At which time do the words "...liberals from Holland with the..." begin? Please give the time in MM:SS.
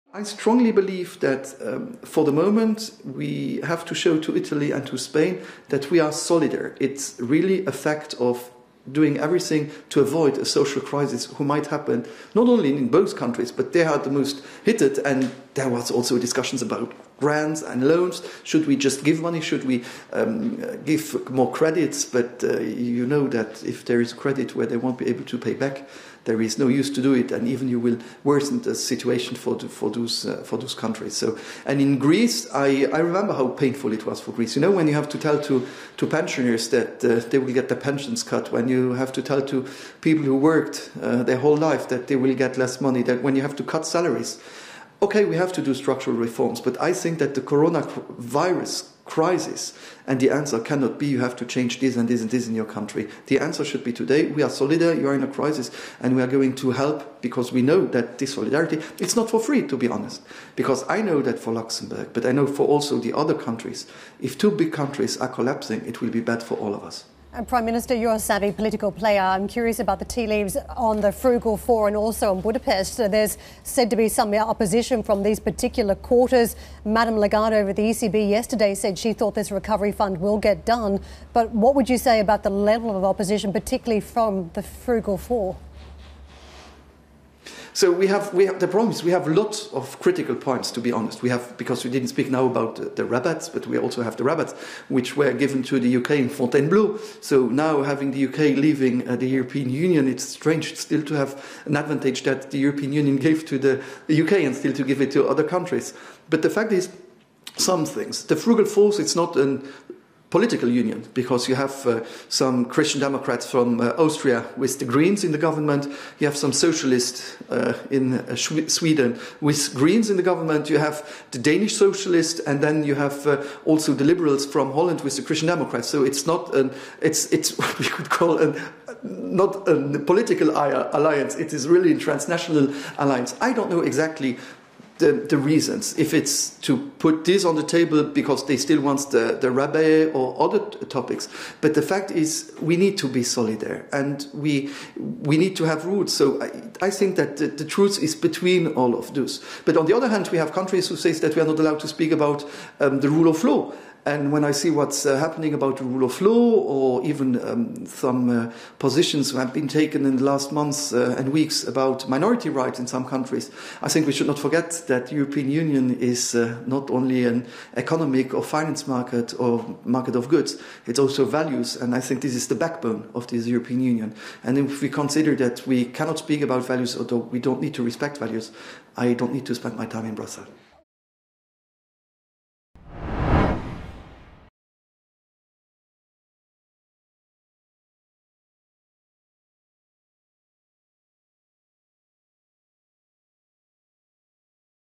02:04.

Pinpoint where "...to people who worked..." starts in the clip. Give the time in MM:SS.
00:39.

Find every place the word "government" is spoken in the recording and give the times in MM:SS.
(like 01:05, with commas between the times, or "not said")
01:55, 02:00.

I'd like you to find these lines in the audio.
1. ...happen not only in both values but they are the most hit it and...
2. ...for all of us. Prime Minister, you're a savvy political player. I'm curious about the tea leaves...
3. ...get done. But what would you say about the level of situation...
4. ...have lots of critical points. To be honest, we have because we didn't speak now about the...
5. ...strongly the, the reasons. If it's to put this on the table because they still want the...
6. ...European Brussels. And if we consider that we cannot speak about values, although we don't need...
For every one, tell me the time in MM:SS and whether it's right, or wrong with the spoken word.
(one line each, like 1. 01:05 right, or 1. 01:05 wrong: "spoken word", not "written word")
1. 00:11 wrong: "countries", not "values"
2. 01:06 right
3. 01:20 wrong: "opposition", not "situation"
4. 01:29 right
5. 02:13 wrong: "exactly", not "strongly"
6. 02:53 wrong: "Union", not "Brussels".